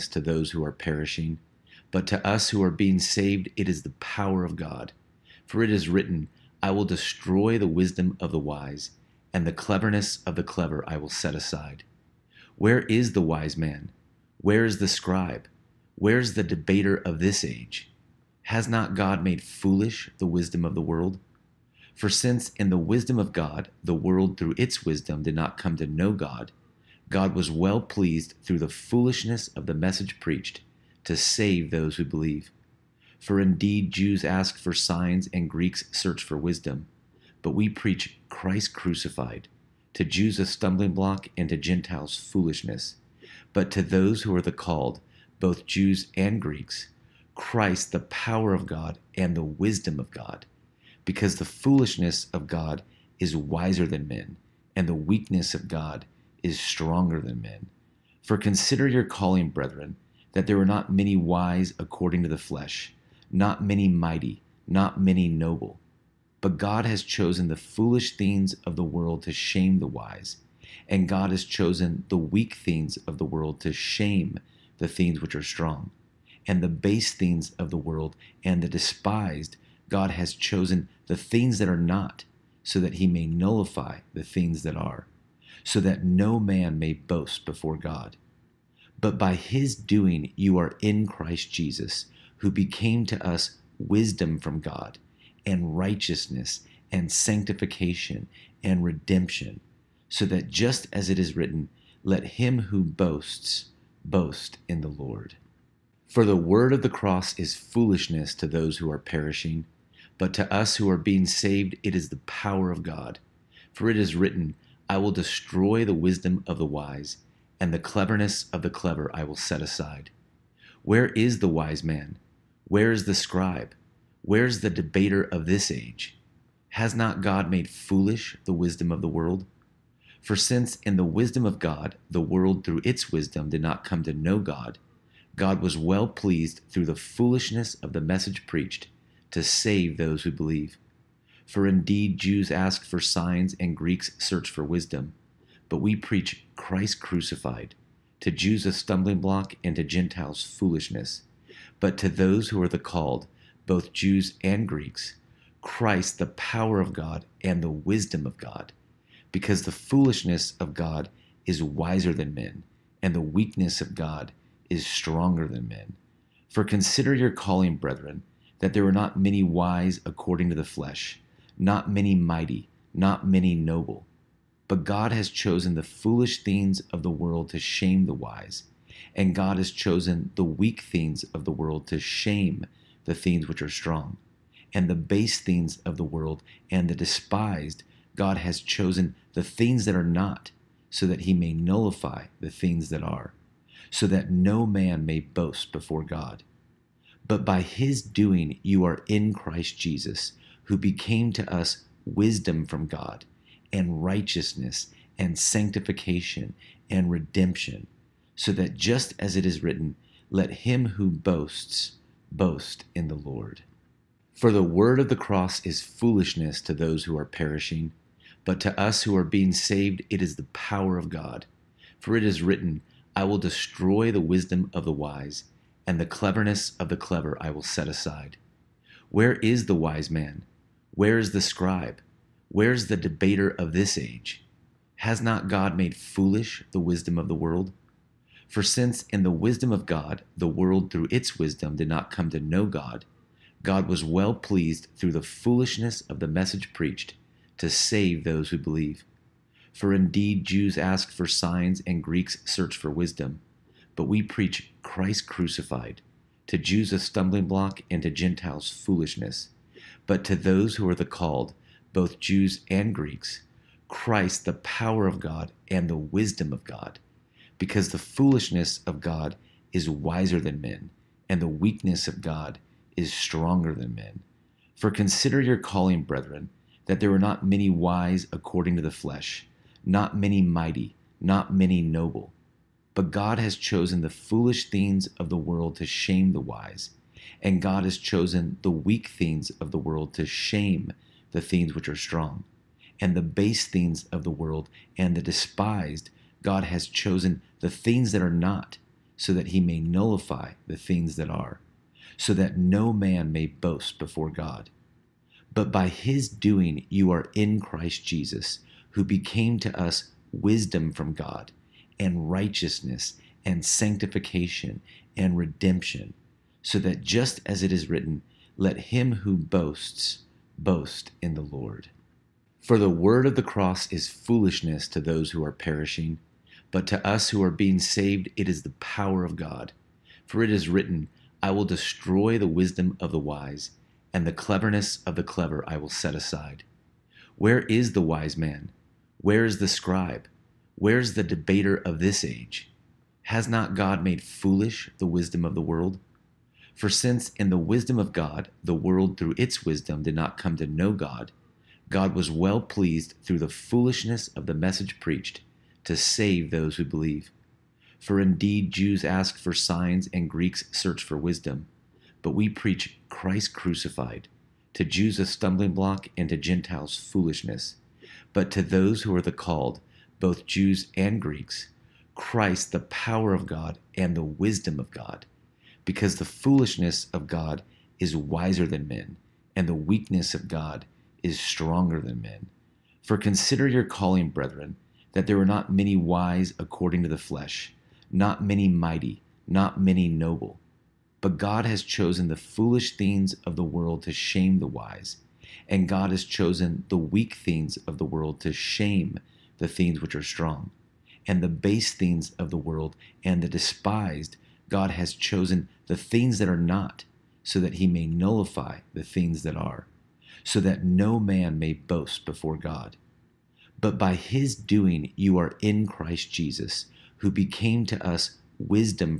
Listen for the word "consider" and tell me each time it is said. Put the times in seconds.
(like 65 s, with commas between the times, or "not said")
58 s, 166 s, 274 s, 383 s.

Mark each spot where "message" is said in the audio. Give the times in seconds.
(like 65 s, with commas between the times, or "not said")
29 s, 138 s, 246 s, 354 s.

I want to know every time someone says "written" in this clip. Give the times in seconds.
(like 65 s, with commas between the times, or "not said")
5 s, 101 s, 114 s, 209 s, 222 s, 317 s, 330 s.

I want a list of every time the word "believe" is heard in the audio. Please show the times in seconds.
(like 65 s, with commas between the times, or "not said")
32 s, 140 s, 248 s, 356 s.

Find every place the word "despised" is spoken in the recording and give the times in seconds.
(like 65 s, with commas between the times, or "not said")
78 s, 186 s, 295 s, 403 s.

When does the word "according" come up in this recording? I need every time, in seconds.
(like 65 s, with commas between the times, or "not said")
61 s, 170 s, 278 s, 386 s.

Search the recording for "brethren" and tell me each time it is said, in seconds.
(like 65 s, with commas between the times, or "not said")
59 s, 167 s, 276 s, 384 s.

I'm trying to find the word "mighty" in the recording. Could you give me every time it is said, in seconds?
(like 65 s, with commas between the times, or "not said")
63 s, 172 s, 280 s, 388 s.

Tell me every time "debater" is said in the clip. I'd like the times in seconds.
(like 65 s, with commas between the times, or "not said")
16 s, 124 s, 232 s, 341 s.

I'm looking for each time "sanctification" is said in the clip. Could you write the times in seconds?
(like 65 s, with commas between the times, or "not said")
97 s, 205 s, 313 s.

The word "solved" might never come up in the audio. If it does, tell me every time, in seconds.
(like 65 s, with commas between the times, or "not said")
not said.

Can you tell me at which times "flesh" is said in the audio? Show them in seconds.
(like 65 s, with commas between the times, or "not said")
62 s, 170 s, 278 s, 387 s.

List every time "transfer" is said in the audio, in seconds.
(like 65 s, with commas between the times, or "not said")
not said.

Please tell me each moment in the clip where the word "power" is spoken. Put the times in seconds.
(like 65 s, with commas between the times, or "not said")
3 s, 47 s, 112 s, 156 s, 220 s, 264 s, 328 s, 372 s.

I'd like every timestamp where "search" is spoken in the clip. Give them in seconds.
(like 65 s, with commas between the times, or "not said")
35 s, 144 s, 252 s, 360 s.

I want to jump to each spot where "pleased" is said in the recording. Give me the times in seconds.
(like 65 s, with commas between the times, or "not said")
27 s, 136 s, 244 s, 352 s.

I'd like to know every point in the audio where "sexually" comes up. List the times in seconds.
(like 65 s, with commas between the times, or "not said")
not said.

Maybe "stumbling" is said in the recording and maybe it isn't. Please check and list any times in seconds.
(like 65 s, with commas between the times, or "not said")
40 s, 148 s, 256 s, 365 s.